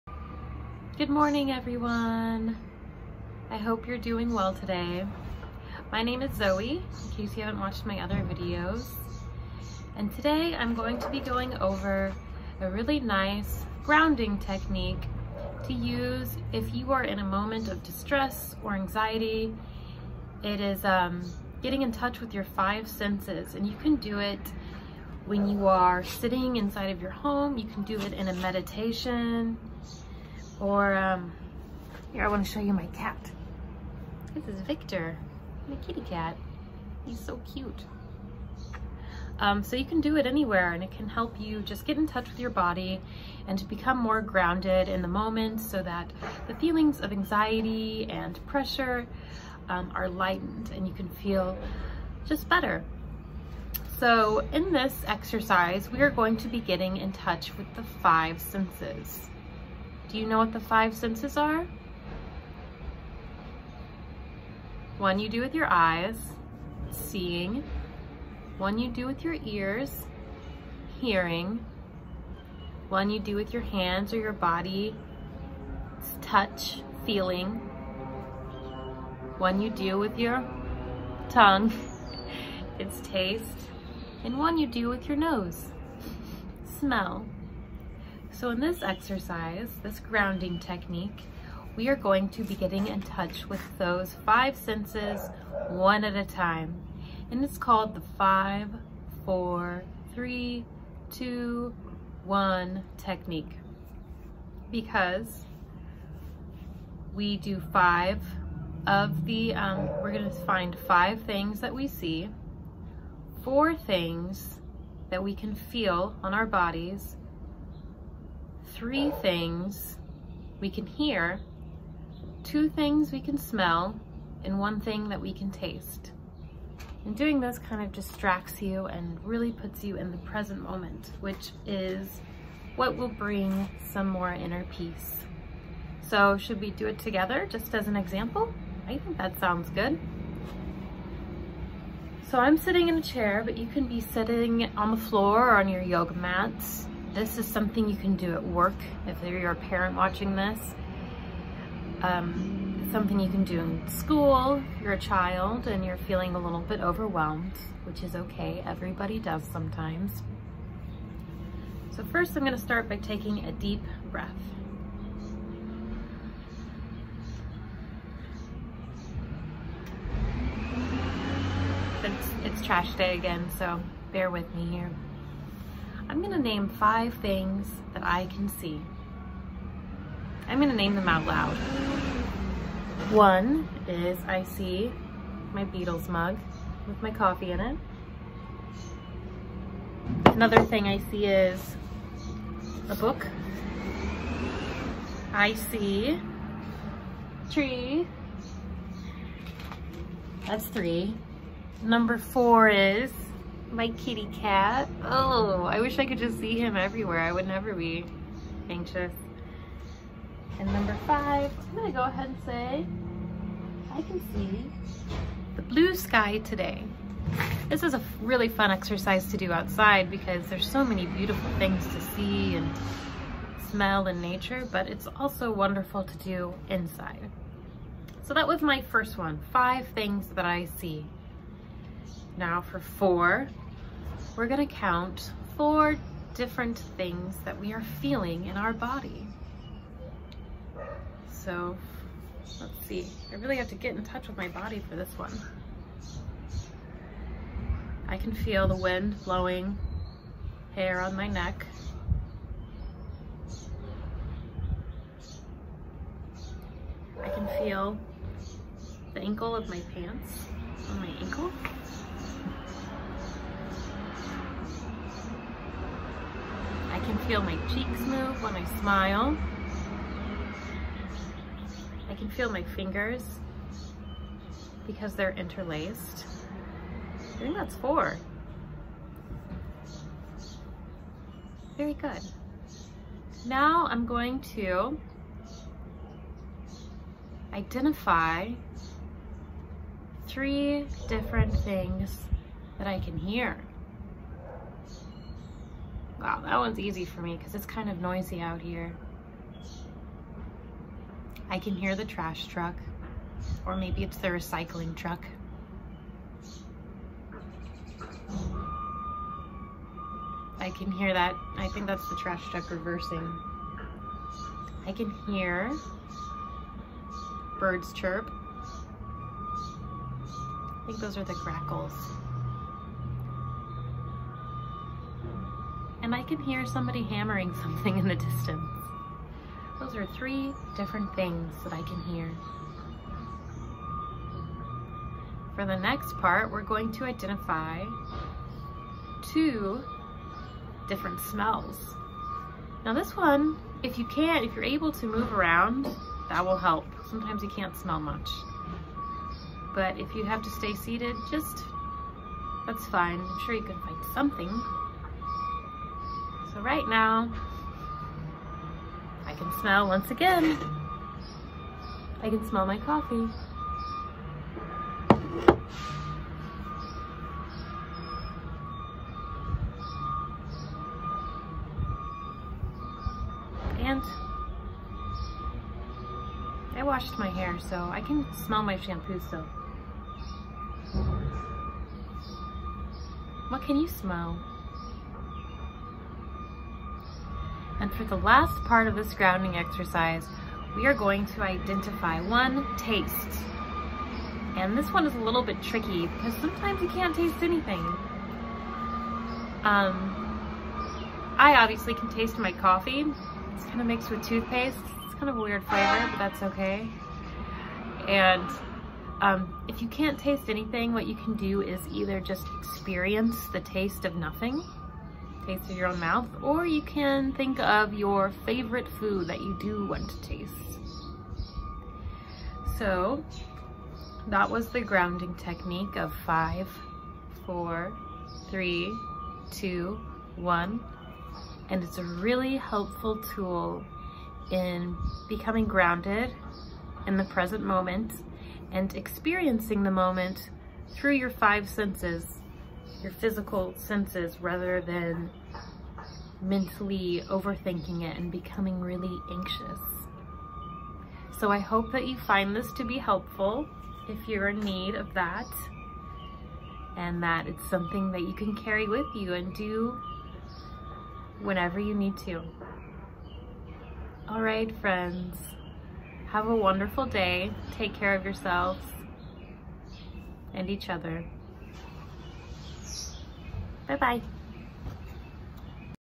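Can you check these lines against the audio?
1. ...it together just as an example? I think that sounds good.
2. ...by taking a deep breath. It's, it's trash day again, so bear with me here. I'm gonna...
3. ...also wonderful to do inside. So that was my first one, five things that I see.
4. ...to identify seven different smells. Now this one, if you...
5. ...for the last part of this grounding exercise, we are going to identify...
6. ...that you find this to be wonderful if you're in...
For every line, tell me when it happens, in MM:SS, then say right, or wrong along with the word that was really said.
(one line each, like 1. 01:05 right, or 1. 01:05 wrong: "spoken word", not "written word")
1. 02:16 right
2. 02:42 right
3. 03:45 right
4. 05:36 wrong: "two", not "seven"
5. 06:27 right
6. 07:31 wrong: "helpful", not "wonderful".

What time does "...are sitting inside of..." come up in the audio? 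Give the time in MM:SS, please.
00:25.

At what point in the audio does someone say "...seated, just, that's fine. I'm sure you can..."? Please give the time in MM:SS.
05:50.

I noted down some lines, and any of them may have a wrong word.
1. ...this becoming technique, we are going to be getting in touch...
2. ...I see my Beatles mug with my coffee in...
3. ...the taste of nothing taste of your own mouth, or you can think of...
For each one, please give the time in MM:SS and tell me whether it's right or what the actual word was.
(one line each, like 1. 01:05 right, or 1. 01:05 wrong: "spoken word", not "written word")
1. 01:29 wrong: "grounding", not "becoming"
2. 03:04 right
3. 06:53 right.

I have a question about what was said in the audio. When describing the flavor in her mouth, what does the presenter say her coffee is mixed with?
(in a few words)
toothpaste.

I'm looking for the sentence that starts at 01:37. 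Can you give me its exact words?
And it's called the five, four, three, two, one technique.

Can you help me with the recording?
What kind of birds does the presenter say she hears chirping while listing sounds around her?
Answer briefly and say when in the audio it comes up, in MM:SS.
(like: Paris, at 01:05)
grackles, at 05:21.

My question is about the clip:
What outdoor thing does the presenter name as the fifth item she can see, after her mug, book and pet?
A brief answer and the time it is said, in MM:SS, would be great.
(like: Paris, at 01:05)
the blue sky, at 03:35.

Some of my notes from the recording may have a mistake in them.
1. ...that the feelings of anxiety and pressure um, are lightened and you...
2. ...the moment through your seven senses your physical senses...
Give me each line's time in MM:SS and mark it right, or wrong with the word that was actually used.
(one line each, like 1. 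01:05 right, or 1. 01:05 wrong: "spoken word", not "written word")
1. 00:45 right
2. 07:19 wrong: "five", not "seven".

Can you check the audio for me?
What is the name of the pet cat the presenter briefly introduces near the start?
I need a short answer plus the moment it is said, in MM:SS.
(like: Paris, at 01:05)
Victor, at 00:34.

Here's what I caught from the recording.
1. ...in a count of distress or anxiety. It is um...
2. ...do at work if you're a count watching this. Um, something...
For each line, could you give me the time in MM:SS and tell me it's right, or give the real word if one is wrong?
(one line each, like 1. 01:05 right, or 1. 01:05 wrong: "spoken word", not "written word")
1. 00:17 wrong: "moment", not "count"
2. 02:28 wrong: "parent", not "count".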